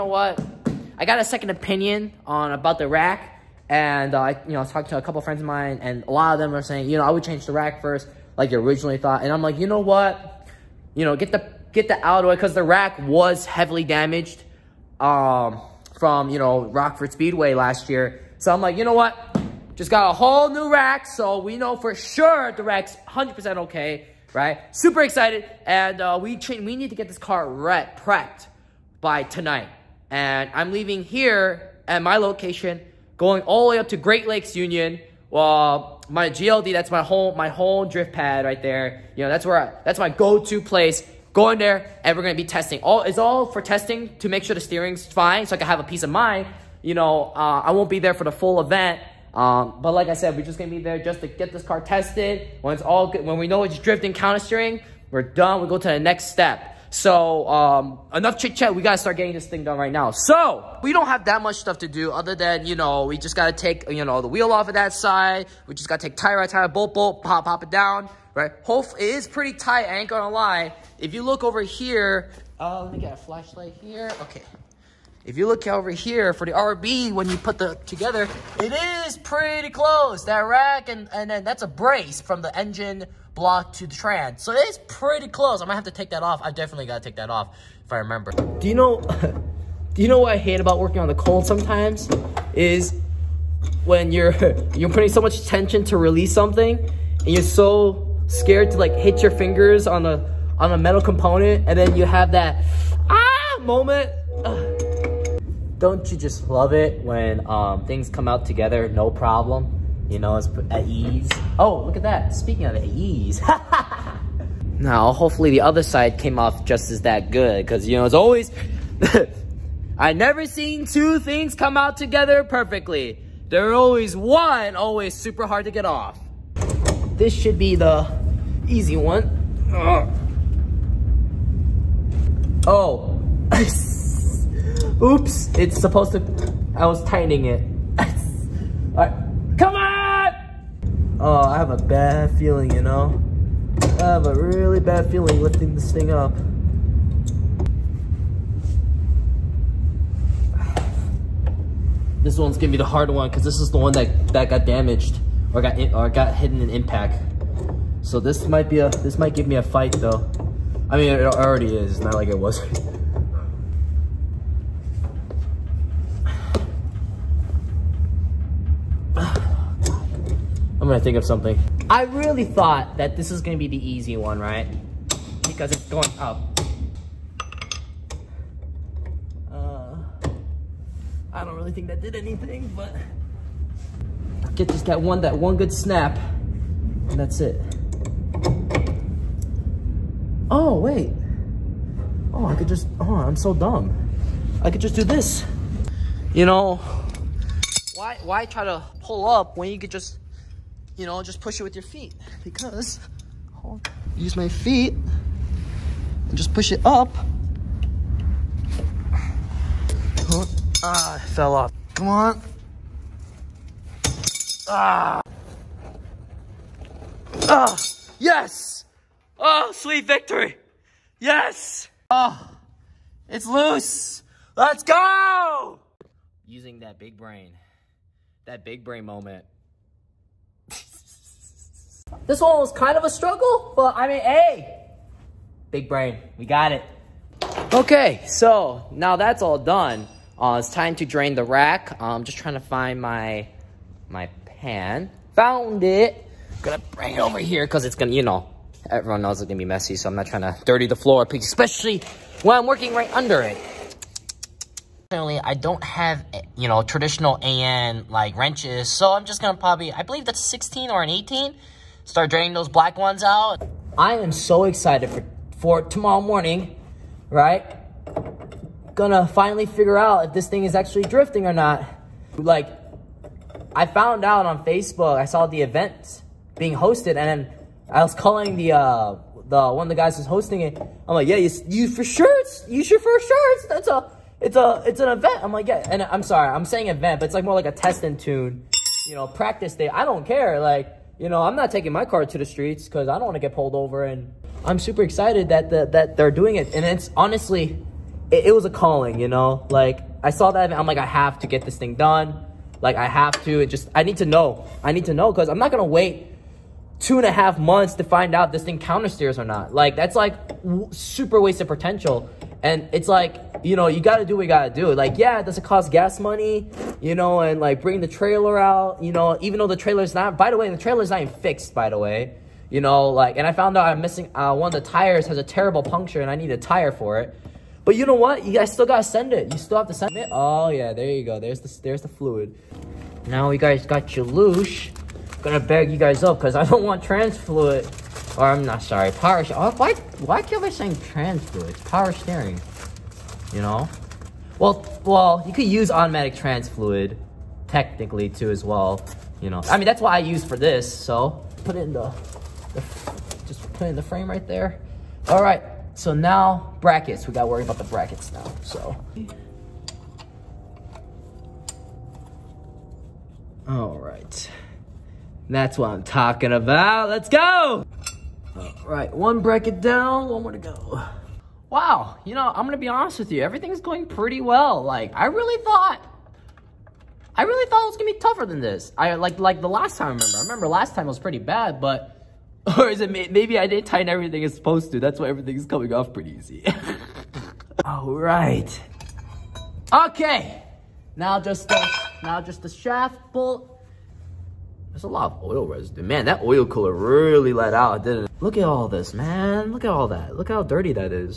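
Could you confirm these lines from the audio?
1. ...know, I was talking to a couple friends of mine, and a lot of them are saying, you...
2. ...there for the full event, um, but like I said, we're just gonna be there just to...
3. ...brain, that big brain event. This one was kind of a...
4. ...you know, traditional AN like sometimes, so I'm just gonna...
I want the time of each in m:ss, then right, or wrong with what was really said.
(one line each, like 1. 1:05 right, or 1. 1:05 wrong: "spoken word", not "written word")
1. 0:04 right
2. 0:47 right
3. 3:47 wrong: "moment", not "event"
4. 4:16 wrong: "wrenches", not "sometimes".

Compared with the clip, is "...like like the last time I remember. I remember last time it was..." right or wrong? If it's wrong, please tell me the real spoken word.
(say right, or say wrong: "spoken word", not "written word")
right.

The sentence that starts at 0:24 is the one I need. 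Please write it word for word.
Super excited, and uh, we we need to get this car ret- prepped by tonight.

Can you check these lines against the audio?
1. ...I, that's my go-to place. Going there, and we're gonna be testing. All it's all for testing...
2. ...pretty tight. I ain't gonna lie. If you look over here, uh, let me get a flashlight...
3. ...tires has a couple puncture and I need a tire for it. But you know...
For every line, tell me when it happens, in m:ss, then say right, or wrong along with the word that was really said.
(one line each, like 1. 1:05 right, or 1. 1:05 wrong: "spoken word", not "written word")
1. 0:39 right
2. 1:09 right
3. 5:24 wrong: "terrible", not "couple".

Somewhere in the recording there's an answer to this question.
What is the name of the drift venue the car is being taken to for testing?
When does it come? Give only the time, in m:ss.
0:33.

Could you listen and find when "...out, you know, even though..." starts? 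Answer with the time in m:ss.
5:18.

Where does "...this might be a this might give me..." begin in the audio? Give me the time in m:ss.
2:38.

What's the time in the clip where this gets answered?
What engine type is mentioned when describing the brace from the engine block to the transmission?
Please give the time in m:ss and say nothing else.
1:16.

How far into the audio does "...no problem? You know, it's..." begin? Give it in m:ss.
1:48.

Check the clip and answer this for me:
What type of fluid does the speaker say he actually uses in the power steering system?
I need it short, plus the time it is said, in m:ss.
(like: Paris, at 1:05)
automatic trans fluid, at 5:45.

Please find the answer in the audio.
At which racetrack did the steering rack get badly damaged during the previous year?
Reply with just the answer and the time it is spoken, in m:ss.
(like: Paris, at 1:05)
Rockford Speedway, at 0:16.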